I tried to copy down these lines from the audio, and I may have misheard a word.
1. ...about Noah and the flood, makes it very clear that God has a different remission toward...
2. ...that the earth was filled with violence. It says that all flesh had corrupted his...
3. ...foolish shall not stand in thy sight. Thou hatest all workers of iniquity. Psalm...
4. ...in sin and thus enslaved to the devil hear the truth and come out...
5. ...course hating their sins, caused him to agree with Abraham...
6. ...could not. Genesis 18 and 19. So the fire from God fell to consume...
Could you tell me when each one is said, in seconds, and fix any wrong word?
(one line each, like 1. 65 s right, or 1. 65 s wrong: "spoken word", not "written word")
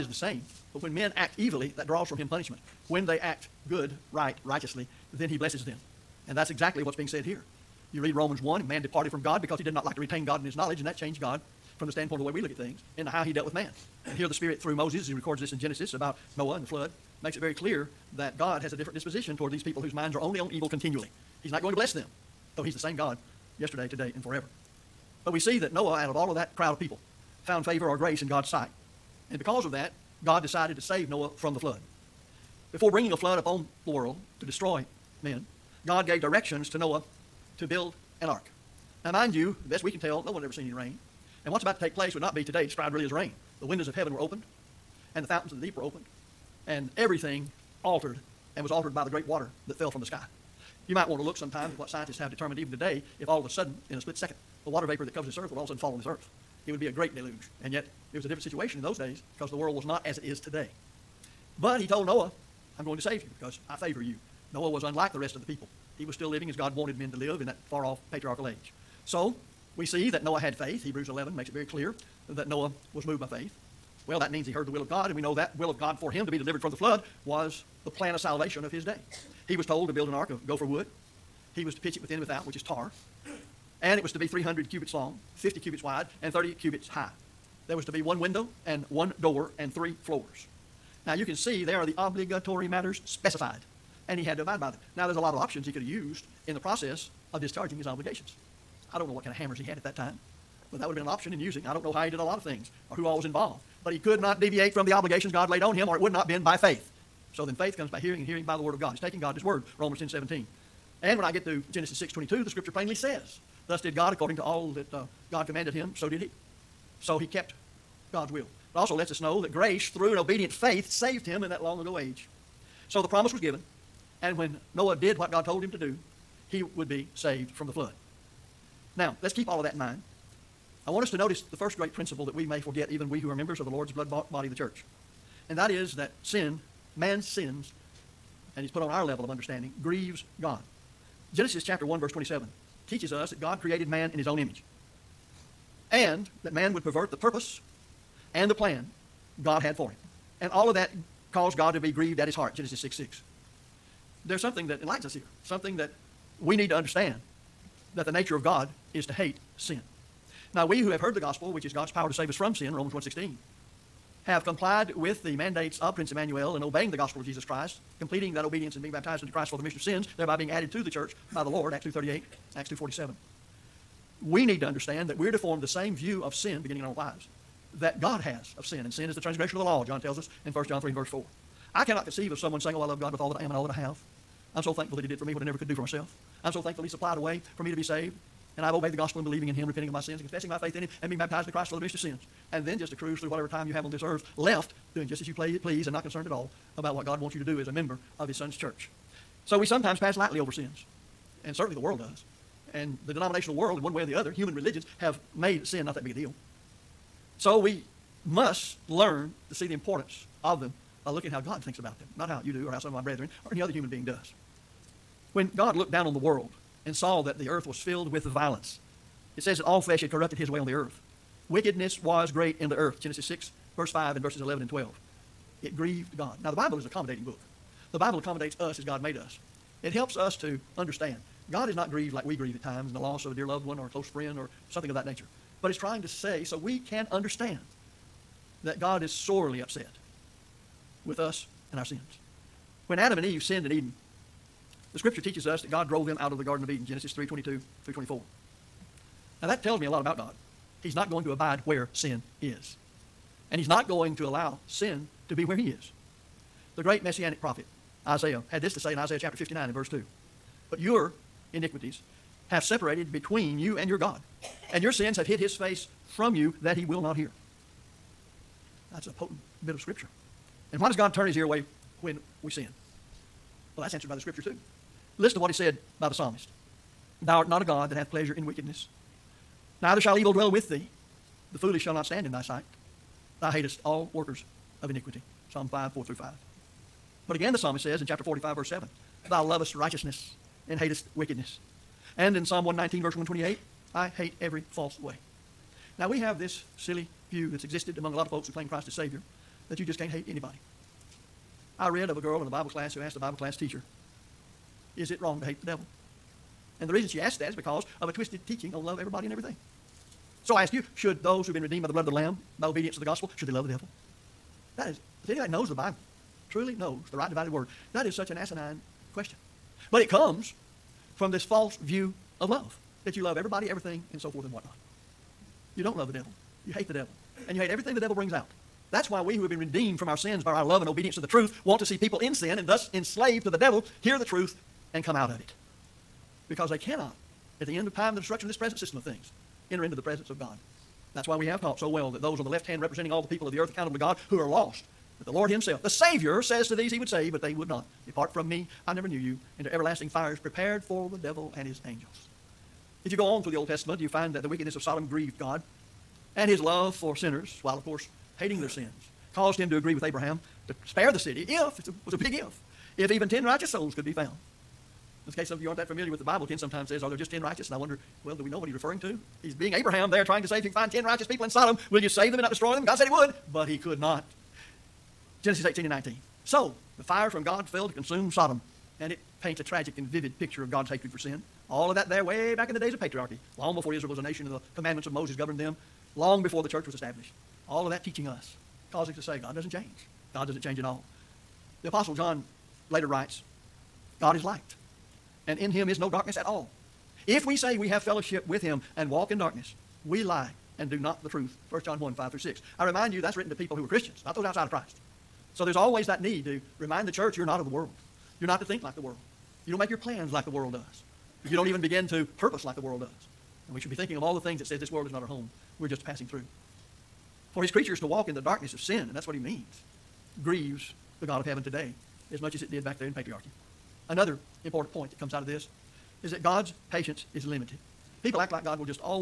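1. 15 s wrong: "disposition", not "remission"
2. 217 s right
3. 281 s right
4. 332 s right
5. 357 s right
6. 373 s right.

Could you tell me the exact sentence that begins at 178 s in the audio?
And sin is the transgression of the law, John tells us in 1 John 3 and verse 4.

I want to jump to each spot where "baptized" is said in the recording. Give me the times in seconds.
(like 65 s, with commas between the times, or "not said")
168 s, 191 s.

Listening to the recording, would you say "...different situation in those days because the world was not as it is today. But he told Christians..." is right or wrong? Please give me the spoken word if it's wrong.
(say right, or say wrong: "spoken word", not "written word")
wrong: "Noah", not "Christians".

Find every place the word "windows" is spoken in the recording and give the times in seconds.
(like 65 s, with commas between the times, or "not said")
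43 s, 88 s.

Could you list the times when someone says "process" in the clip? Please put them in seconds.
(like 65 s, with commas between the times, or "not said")
96 s.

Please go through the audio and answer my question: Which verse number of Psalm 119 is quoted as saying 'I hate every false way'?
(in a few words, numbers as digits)
128.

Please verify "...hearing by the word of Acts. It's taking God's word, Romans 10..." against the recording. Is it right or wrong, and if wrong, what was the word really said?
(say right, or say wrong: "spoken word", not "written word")
wrong: "God", not "Acts".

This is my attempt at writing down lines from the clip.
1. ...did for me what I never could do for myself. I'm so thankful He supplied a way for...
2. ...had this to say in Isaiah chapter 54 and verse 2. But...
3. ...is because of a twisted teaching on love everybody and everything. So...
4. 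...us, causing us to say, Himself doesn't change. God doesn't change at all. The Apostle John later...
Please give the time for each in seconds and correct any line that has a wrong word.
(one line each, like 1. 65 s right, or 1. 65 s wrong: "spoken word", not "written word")
1. 185 s right
2. 258 s wrong: "59", not "54"
3. 307 s right
4. 388 s wrong: "God", not "Himself".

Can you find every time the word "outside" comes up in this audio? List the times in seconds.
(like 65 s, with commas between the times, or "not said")
404 s.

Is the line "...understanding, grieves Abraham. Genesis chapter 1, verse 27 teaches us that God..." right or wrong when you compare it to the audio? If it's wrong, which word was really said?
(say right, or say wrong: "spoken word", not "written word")
wrong: "God", not "Abraham".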